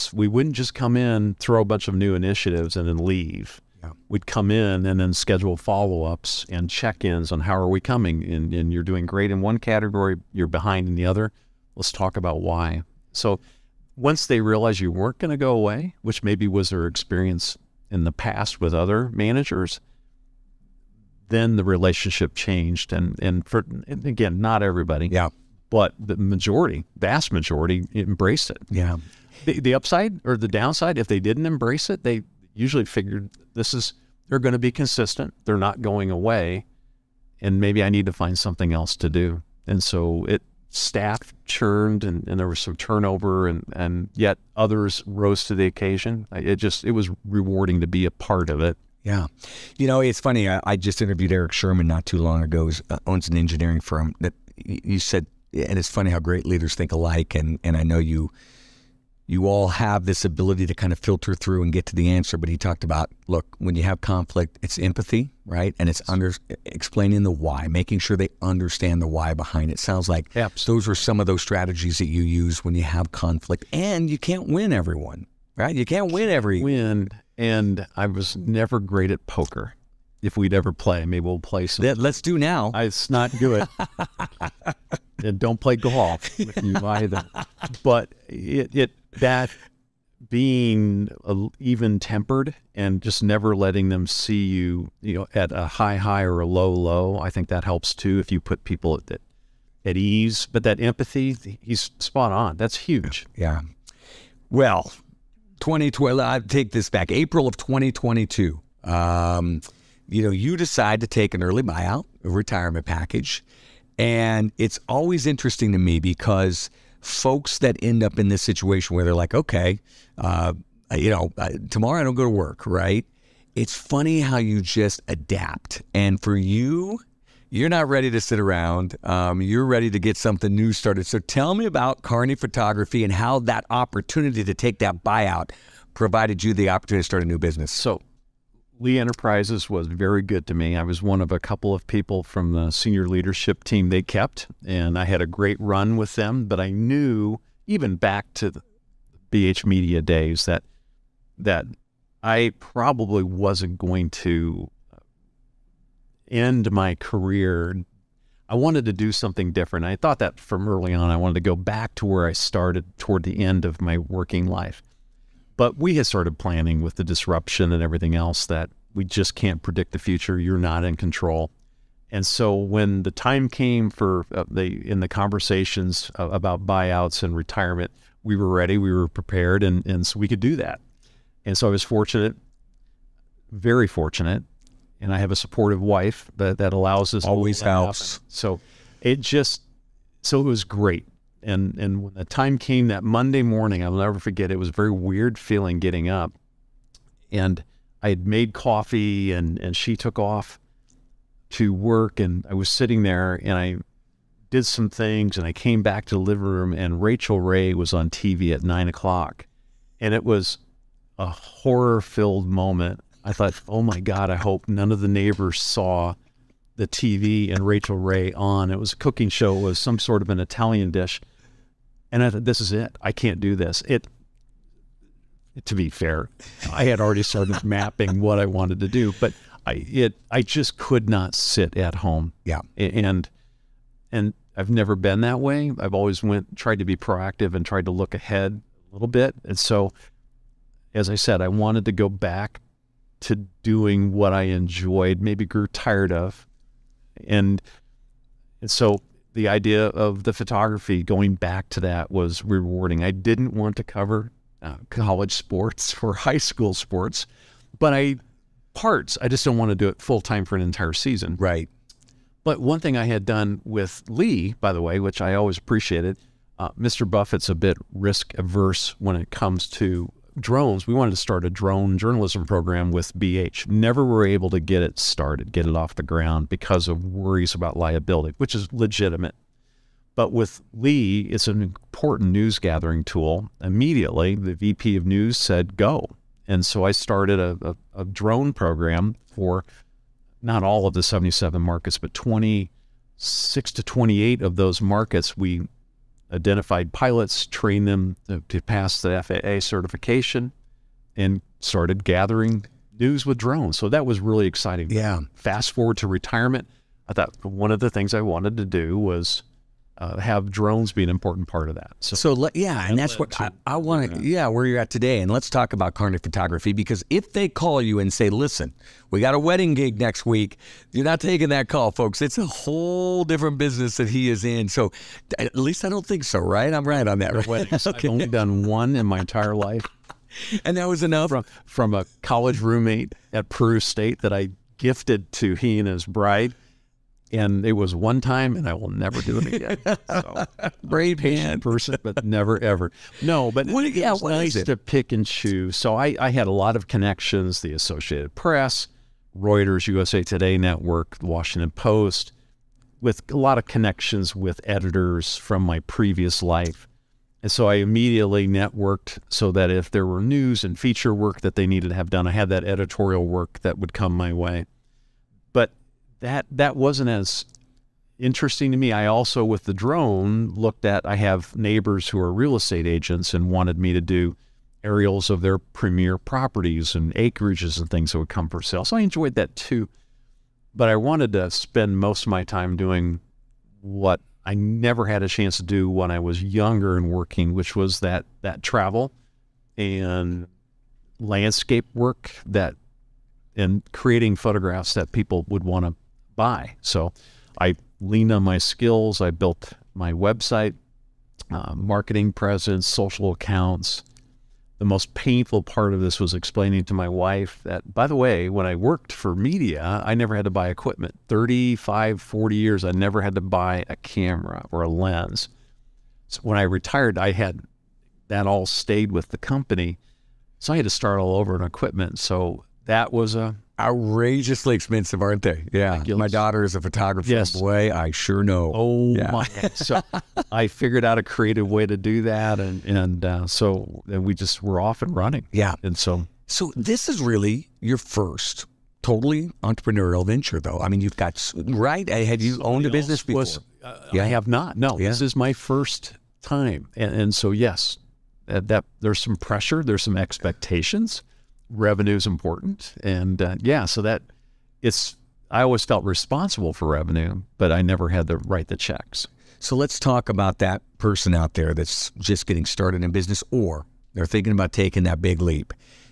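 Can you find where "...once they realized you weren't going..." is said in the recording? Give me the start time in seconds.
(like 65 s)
13 s.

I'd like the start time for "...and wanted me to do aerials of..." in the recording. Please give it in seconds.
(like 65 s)
373 s.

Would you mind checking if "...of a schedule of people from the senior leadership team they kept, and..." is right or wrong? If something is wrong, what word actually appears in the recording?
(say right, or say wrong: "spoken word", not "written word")
wrong: "couple", not "schedule".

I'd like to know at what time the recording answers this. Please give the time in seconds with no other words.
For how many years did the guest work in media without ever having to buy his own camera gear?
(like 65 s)
411 s.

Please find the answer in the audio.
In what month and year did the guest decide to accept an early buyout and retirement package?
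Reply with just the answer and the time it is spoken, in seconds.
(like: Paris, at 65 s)
April 2022, at 107 s.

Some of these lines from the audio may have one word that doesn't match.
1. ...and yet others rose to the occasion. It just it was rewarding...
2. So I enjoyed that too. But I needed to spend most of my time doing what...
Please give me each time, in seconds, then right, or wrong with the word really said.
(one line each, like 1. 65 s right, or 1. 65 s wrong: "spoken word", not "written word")
1. 43 s right
2. 378 s wrong: "wanted", not "needed".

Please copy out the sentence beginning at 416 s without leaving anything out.
So when I retired, I had that all stayed with the company.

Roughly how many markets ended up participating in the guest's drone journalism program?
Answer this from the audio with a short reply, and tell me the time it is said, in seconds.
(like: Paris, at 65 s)
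26 to 28, at 292 s.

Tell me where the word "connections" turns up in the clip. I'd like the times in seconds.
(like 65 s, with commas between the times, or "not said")
346 s, 353 s.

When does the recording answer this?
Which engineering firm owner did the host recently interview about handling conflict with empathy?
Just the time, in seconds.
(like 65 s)
51 s.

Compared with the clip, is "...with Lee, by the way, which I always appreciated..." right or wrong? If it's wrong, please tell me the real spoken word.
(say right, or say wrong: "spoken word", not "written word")
right.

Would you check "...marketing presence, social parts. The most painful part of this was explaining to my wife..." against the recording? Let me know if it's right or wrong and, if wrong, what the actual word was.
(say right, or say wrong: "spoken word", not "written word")
wrong: "accounts", not "parts".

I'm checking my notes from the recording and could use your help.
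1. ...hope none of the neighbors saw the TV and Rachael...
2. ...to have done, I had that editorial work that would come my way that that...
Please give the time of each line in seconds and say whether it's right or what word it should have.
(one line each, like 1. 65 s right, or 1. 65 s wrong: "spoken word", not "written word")
1. 214 s right
2. 361 s right.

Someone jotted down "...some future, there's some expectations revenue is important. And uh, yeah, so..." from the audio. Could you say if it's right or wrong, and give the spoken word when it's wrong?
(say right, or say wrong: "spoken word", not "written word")
wrong: "pressure", not "future".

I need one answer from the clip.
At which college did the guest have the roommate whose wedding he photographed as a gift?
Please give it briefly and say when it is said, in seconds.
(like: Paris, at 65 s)
Peru State, at 333 s.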